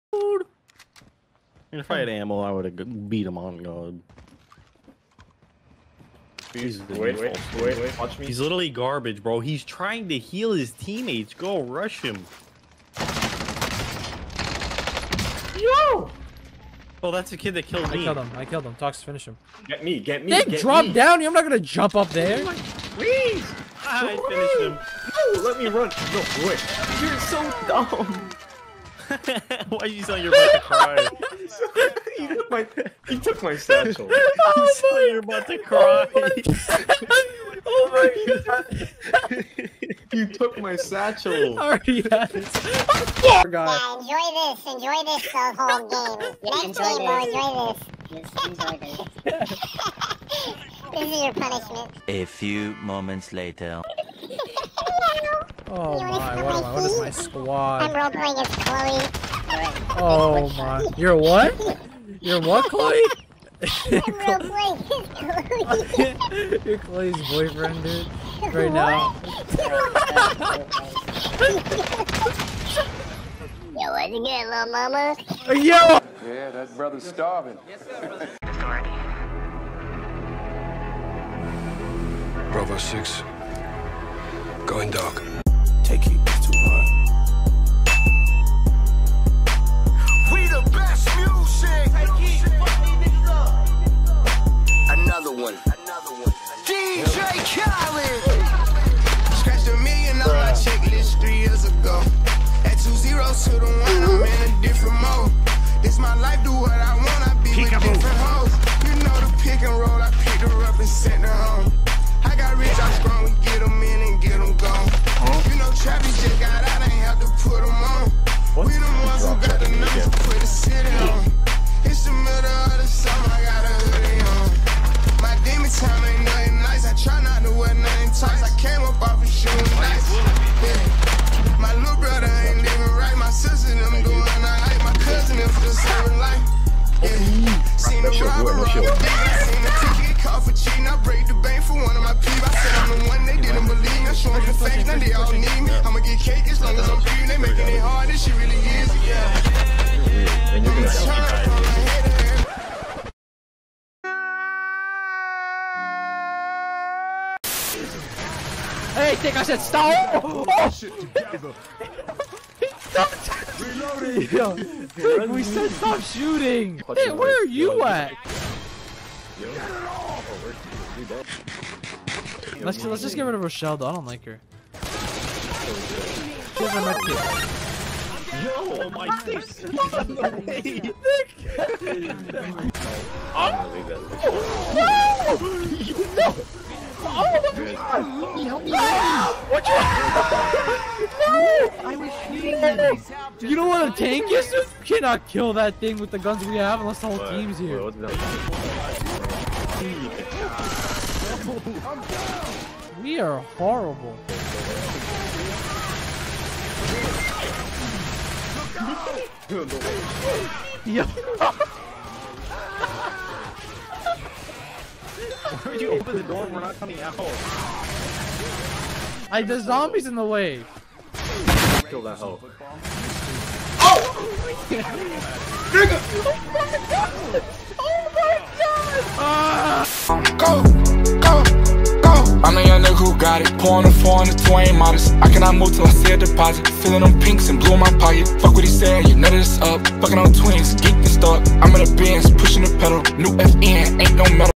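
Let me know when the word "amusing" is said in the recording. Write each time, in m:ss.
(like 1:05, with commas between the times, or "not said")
not said.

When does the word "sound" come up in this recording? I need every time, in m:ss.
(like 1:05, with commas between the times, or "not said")
0:30.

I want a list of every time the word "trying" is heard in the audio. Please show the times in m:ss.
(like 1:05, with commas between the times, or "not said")
0:09.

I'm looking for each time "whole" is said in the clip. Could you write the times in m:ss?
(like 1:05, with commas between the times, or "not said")
0:45, 3:17.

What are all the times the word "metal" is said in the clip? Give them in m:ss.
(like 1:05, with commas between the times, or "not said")
4:04.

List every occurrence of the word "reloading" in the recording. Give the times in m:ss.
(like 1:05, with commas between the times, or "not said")
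2:43.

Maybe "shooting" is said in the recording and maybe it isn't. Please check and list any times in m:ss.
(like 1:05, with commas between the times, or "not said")
2:46, 3:12.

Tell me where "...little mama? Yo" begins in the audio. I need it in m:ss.
1:14.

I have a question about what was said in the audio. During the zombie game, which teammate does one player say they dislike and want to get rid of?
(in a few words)
Rochelle.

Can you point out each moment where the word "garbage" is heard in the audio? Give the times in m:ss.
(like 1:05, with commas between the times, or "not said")
0:08.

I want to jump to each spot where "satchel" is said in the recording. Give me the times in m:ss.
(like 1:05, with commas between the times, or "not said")
0:33, 0:40.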